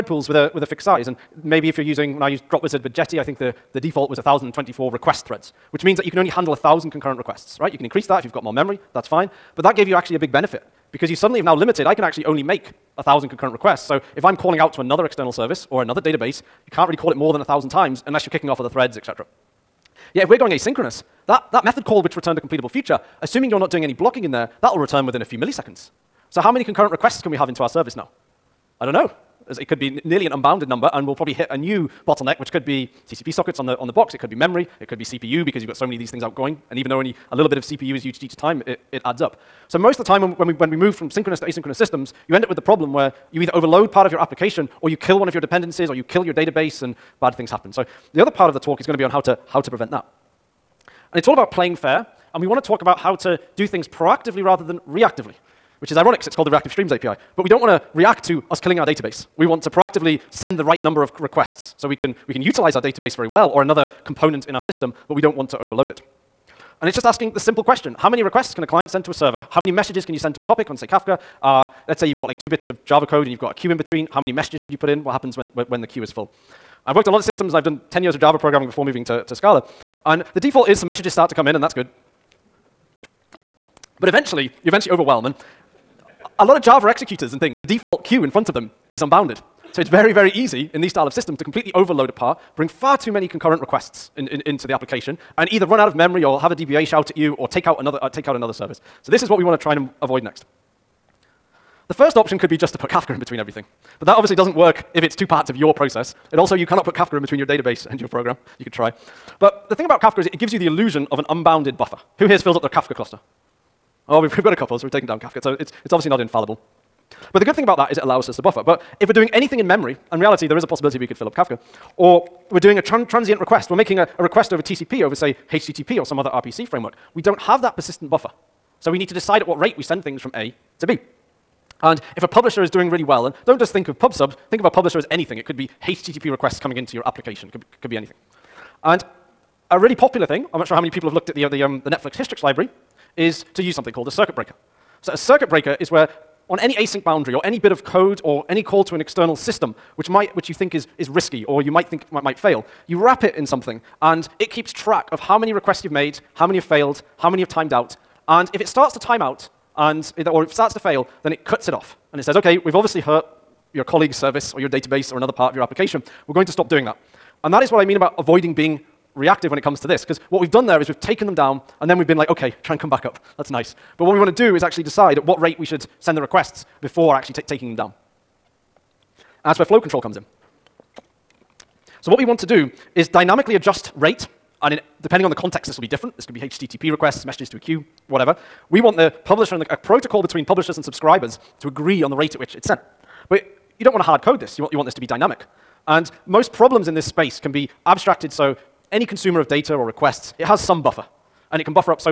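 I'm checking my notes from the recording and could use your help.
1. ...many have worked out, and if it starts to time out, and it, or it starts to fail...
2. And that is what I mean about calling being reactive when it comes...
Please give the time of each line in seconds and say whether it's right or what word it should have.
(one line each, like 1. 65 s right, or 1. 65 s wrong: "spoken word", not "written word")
1. 157 s wrong: "timed", not "worked"
2. 167 s wrong: "avoiding", not "calling".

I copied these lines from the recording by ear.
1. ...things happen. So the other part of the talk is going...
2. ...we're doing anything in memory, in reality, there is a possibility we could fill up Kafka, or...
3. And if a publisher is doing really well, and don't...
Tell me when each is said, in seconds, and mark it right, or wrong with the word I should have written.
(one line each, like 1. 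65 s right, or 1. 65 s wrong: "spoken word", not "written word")
1. 47 s right
2. 119 s right
3. 131 s right.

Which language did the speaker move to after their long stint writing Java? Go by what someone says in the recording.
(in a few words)
Scala.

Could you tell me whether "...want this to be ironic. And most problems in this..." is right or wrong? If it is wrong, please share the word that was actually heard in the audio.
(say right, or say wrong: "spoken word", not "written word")
wrong: "dynamic", not "ironic".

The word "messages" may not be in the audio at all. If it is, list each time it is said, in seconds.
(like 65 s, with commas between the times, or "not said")
69 s, 74 s, 80 s, 187 s.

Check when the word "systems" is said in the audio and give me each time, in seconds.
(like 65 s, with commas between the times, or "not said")
41 s, 64 s, 77 s, 91 s, 149 s.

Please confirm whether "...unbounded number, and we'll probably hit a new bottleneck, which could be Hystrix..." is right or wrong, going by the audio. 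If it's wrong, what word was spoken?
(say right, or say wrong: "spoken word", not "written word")
wrong: "TCP", not "Hystrix".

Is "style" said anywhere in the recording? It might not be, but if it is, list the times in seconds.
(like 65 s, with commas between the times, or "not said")
90 s.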